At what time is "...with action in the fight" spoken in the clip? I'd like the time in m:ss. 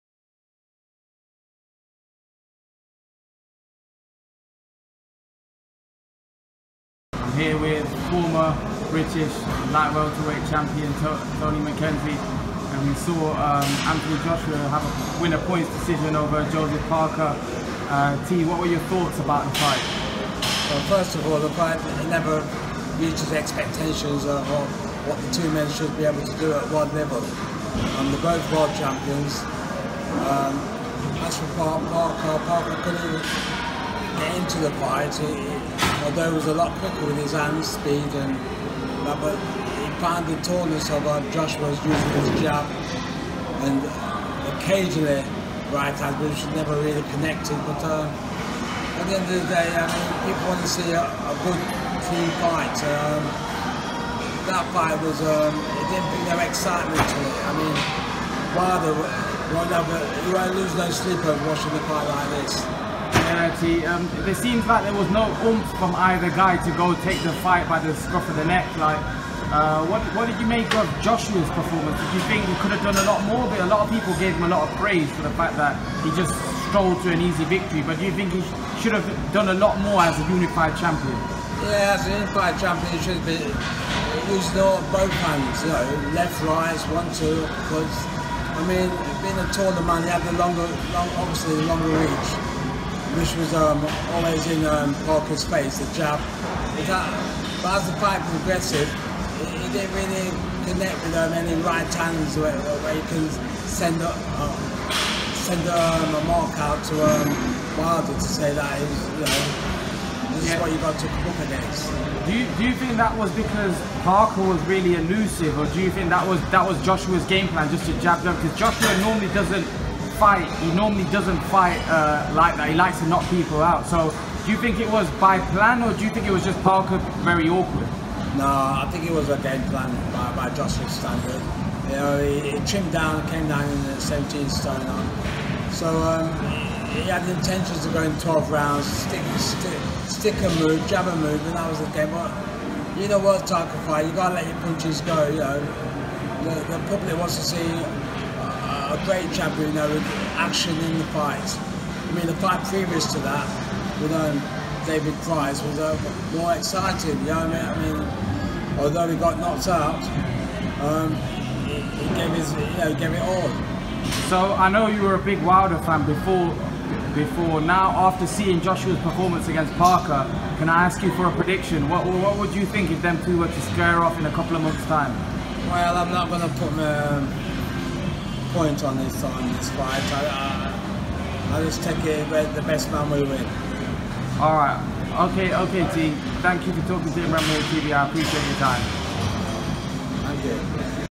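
2:29.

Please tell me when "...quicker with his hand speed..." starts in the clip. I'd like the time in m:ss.
0:36.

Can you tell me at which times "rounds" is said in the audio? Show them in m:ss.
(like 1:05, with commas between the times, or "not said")
2:18.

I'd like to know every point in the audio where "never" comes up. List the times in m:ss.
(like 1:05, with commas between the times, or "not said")
0:22, 0:46.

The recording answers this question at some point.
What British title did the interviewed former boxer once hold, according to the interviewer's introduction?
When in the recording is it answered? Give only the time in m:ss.
0:09.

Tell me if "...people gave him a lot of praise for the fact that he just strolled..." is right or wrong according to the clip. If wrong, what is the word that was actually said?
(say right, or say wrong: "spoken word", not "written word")
right.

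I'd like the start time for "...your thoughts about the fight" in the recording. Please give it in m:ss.
0:18.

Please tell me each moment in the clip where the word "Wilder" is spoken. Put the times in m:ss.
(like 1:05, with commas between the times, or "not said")
1:47, 2:45.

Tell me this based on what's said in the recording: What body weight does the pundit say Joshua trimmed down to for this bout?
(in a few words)
17 stone.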